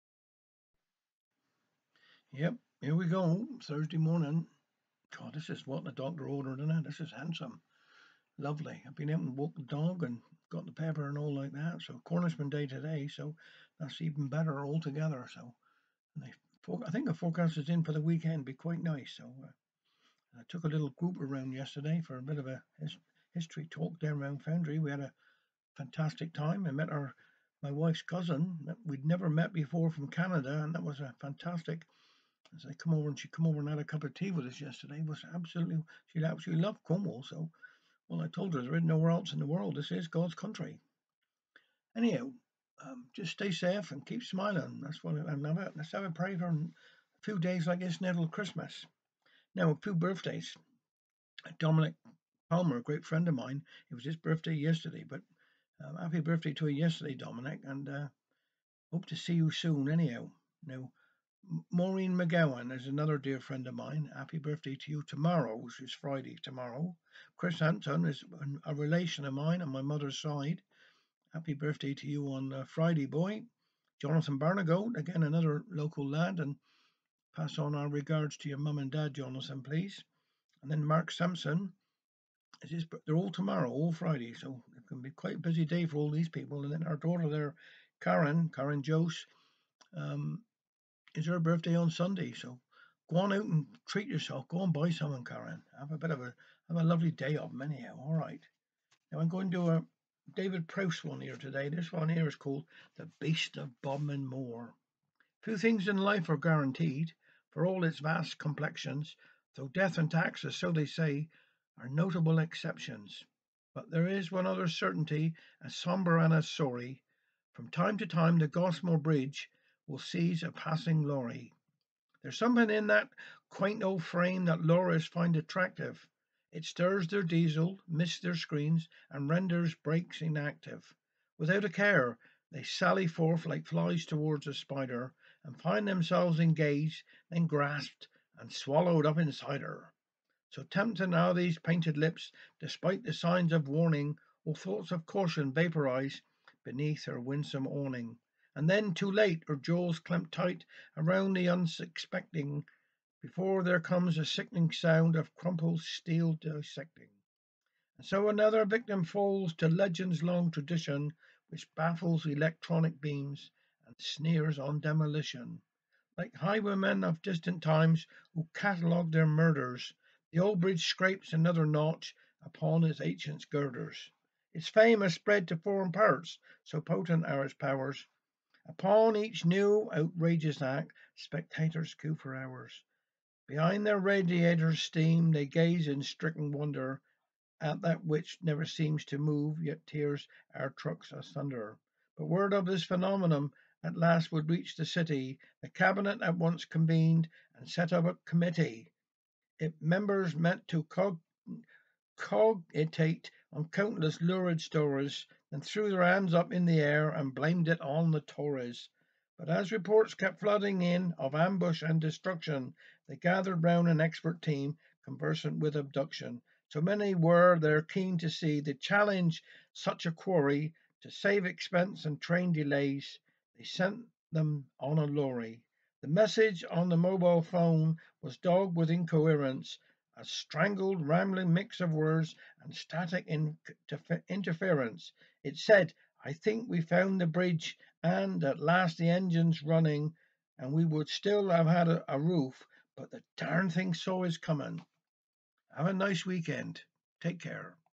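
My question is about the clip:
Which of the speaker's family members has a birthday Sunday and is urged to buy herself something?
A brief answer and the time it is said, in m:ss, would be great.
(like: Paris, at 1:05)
Karen Jose, at 1:28.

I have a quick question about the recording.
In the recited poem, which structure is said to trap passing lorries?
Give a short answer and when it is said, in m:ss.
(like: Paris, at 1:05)
Goss Moor Bridge, at 1:58.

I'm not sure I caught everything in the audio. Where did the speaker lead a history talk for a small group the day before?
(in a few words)
Foundry.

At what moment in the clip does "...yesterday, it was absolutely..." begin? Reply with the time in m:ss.
0:34.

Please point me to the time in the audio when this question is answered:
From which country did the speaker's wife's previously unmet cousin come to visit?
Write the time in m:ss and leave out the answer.
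0:30.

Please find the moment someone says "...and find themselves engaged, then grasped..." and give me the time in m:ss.
2:15.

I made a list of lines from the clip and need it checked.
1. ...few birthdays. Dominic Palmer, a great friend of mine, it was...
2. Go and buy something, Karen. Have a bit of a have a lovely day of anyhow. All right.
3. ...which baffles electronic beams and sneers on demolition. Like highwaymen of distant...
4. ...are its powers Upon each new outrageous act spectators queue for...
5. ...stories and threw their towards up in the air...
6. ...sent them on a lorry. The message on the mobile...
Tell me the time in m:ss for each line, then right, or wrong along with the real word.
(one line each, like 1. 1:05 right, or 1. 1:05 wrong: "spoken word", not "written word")
1. 0:49 right
2. 1:34 right
3. 2:41 right
4. 2:57 right
5. 3:24 wrong: "hands", not "towards"
6. 3:43 right.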